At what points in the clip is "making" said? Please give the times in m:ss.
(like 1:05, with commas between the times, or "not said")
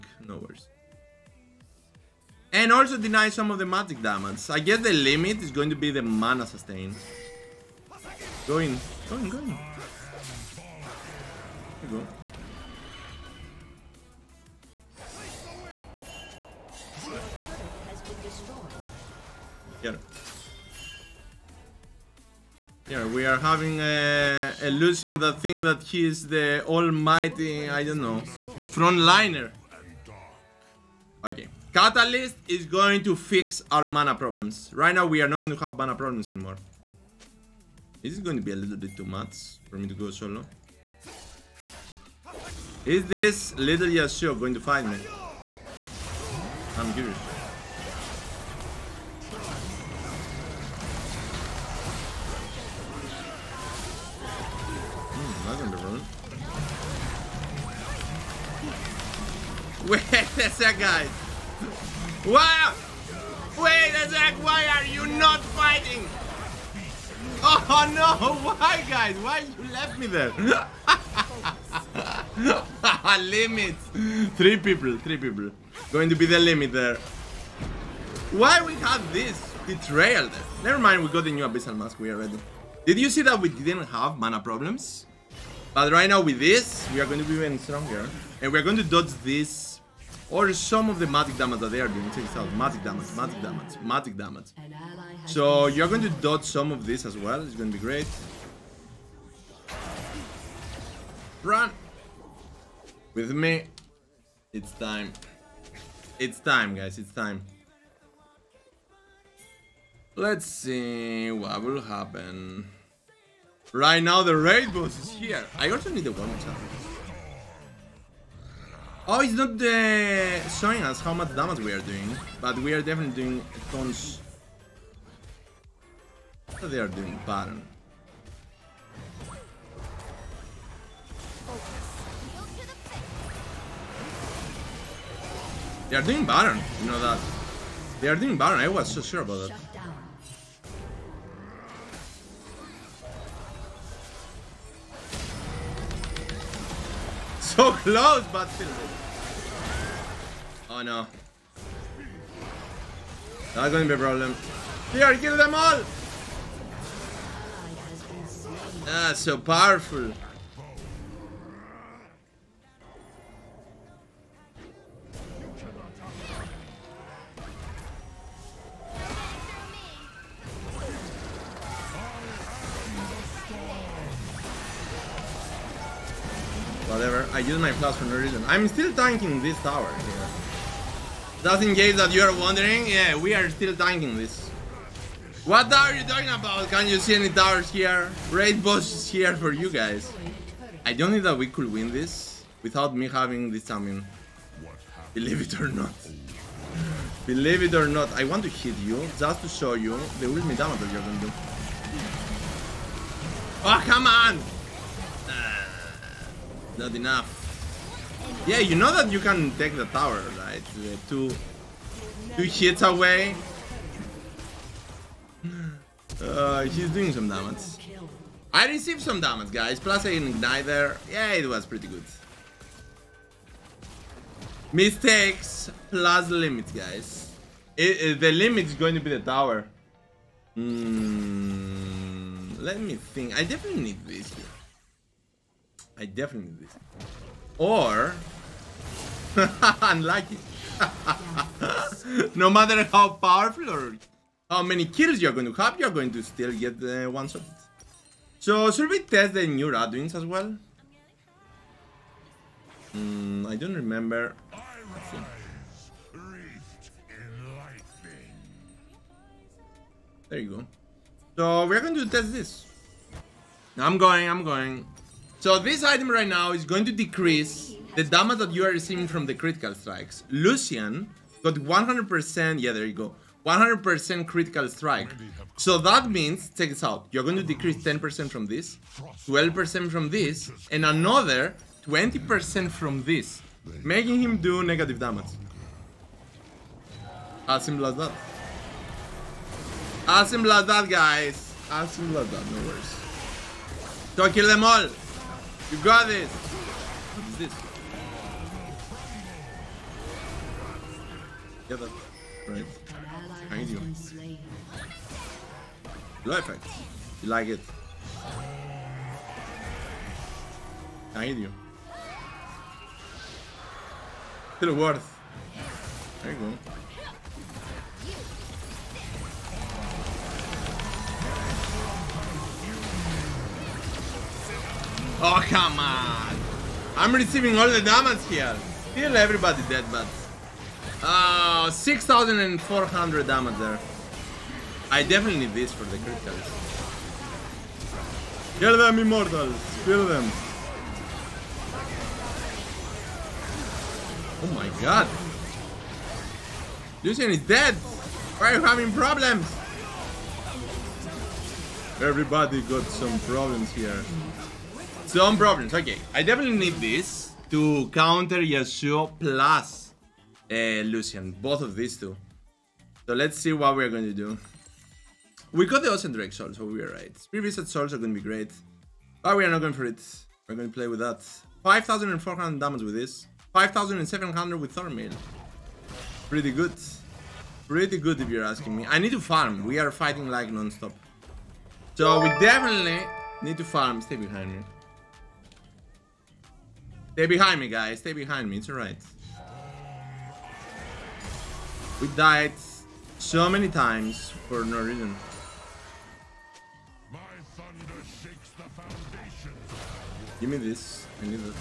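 4:43.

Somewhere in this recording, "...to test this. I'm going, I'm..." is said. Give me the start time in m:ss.
4:21.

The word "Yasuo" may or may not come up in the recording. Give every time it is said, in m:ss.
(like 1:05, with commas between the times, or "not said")
0:43, 5:58.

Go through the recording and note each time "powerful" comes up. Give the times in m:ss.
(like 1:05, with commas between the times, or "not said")
2:39, 4:03.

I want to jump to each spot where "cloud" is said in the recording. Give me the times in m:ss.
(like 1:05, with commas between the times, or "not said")
not said.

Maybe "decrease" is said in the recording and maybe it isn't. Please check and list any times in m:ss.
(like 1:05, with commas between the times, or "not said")
4:26, 4:37.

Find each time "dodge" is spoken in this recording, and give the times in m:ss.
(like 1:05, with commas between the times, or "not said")
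1:28, 1:36.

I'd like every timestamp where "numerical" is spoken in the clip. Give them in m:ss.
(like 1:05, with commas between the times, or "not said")
not said.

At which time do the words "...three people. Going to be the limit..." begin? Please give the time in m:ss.
1:14.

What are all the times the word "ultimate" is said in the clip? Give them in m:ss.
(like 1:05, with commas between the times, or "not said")
3:20.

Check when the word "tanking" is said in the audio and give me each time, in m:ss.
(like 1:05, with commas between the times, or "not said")
2:58, 3:03.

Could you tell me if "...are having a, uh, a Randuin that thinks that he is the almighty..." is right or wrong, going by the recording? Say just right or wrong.
wrong.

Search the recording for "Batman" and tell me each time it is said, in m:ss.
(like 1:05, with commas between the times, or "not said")
not said.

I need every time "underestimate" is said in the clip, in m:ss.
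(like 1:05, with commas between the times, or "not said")
not said.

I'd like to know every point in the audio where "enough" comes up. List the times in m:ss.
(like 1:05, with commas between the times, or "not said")
3:26.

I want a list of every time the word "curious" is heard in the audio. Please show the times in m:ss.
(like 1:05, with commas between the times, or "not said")
0:46.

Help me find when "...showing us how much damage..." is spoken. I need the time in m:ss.
2:00.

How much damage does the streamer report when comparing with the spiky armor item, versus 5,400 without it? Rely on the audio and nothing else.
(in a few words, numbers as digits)
5,700.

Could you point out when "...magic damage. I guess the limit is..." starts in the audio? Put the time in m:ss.
0:03.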